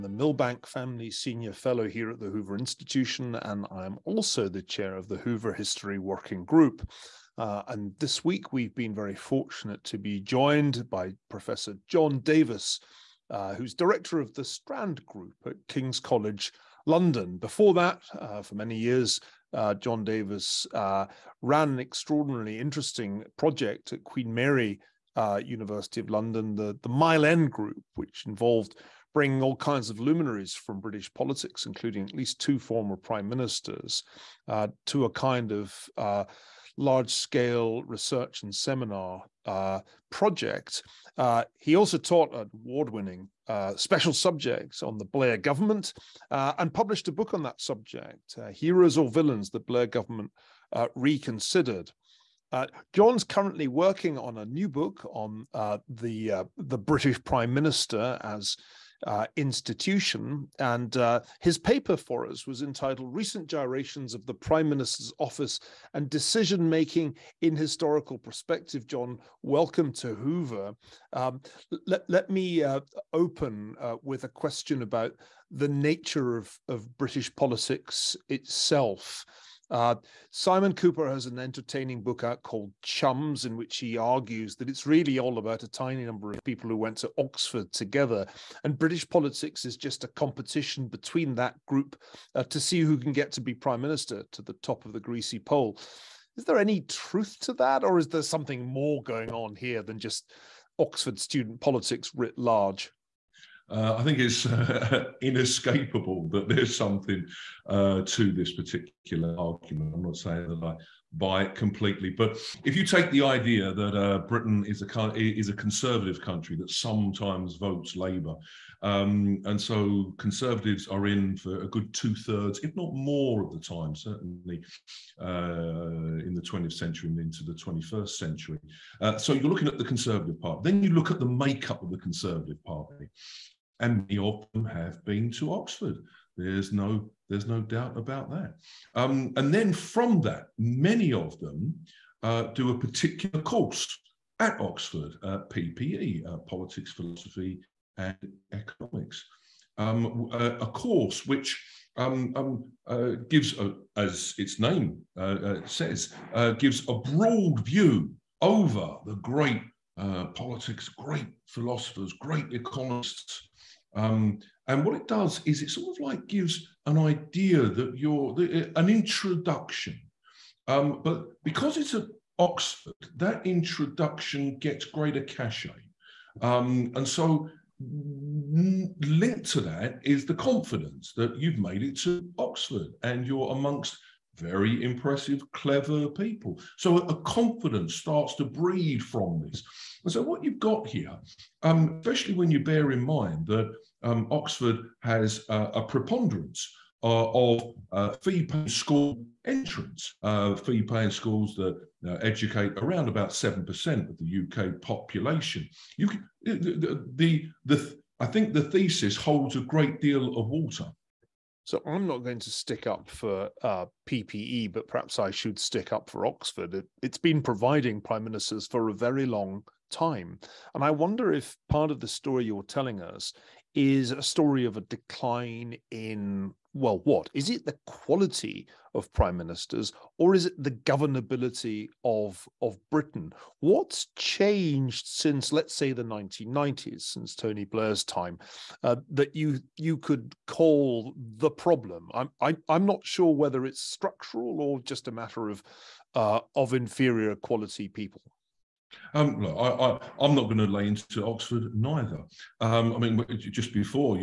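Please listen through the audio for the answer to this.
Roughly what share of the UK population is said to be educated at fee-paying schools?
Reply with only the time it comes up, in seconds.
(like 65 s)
203 s.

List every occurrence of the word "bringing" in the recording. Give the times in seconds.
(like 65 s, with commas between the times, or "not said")
29 s.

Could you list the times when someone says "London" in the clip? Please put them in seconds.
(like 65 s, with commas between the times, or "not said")
16 s, 26 s.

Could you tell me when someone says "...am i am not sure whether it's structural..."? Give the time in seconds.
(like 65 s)
242 s.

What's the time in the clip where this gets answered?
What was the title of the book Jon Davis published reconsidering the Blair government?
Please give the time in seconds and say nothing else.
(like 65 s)
48 s.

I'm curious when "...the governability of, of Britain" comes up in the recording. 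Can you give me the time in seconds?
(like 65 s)
230 s.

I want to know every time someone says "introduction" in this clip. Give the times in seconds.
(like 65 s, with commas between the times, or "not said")
168 s, 173 s.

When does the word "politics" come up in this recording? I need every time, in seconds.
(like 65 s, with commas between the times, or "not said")
31 s, 77 s, 89 s, 101 s, 146 s, 160 s.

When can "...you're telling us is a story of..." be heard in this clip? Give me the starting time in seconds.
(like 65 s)
222 s.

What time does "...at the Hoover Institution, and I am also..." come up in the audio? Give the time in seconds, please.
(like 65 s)
2 s.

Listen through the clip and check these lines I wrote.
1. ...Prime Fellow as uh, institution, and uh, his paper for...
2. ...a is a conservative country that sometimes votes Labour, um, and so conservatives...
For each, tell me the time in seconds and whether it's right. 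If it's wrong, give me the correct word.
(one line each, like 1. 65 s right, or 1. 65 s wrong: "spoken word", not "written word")
1. 57 s wrong: "Minister", not "Fellow"
2. 114 s right.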